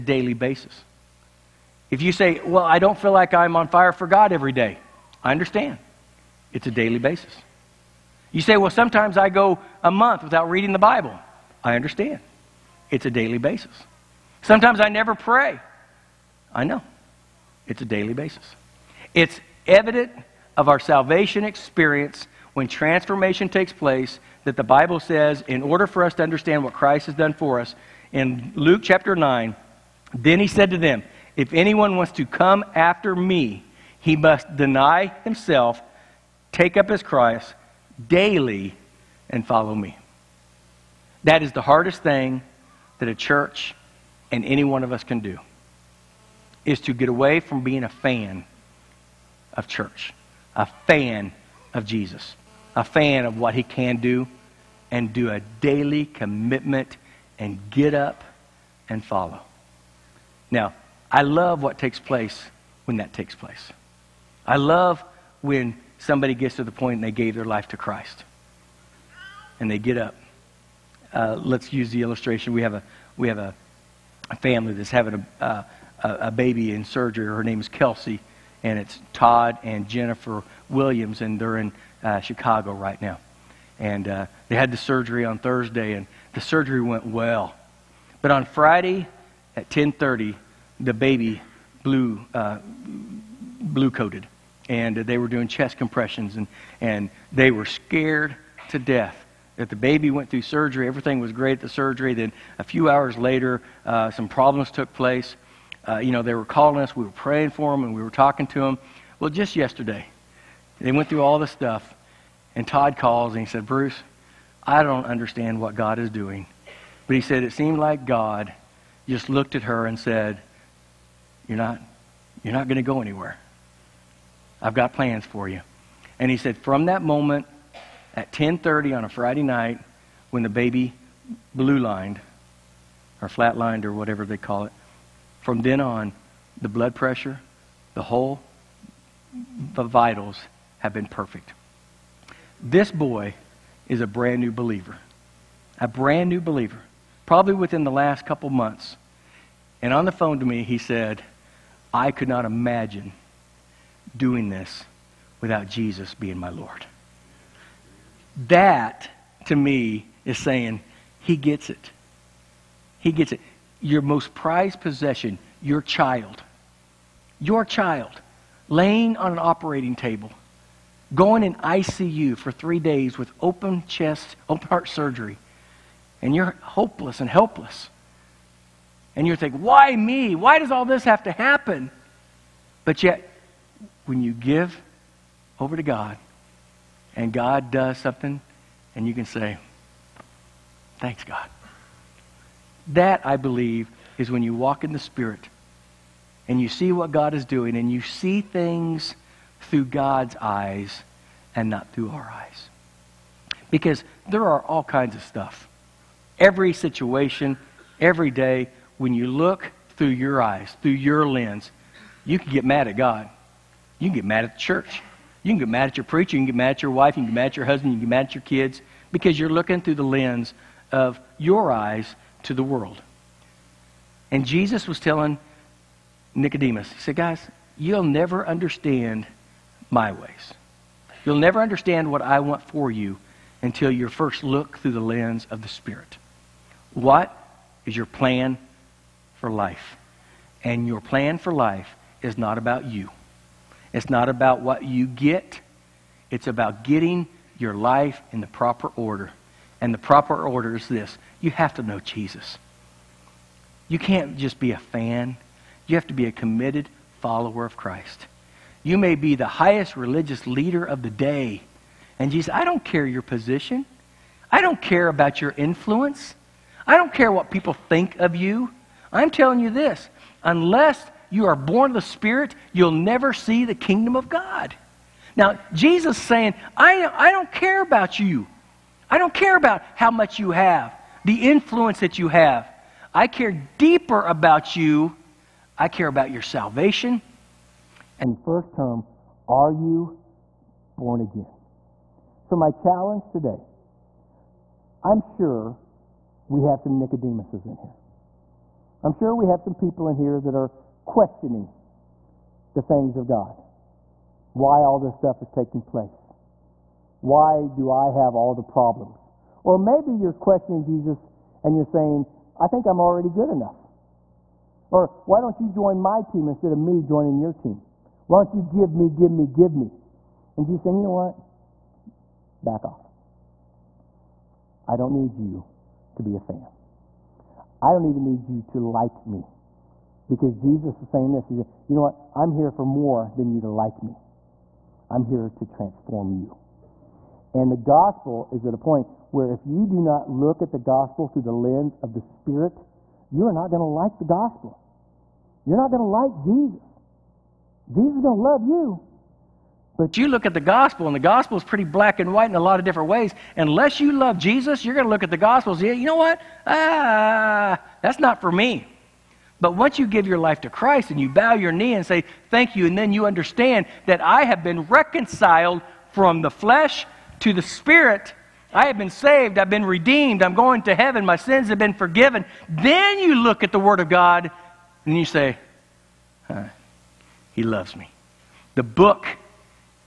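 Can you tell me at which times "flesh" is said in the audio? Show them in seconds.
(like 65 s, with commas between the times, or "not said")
366 s.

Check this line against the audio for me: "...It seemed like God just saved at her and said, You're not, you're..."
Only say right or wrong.
wrong.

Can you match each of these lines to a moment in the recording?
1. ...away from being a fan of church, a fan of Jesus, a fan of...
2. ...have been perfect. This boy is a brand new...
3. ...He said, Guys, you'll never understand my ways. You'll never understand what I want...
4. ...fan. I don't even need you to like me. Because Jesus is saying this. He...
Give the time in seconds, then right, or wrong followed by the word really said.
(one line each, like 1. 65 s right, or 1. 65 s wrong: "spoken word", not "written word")
1. 47 s right
2. 140 s right
3. 226 s right
4. 326 s right.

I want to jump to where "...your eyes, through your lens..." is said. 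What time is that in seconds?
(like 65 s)
210 s.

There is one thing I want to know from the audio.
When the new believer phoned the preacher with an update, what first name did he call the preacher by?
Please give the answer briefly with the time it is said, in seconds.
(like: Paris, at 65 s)
Bruce, at 113 s.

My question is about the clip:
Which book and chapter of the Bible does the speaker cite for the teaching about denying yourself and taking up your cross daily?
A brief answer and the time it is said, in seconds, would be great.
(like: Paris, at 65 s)
Luke chapter 9, at 28 s.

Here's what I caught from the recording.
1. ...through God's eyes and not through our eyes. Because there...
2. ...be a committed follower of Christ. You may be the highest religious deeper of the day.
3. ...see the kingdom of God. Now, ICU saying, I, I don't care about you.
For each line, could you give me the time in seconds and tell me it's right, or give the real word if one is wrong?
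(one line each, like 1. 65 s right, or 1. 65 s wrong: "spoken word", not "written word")
1. 199 s right
2. 256 s wrong: "leader", not "deeper"
3. 273 s wrong: "Jesus", not "ICU".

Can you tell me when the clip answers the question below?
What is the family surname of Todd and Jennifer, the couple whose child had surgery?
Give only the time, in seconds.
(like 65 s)
80 s.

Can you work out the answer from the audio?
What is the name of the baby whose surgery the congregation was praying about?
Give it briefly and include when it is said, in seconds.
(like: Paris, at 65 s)
Kelsey, at 77 s.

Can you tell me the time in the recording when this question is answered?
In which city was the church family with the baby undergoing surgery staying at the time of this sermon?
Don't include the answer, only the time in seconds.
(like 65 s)
82 s.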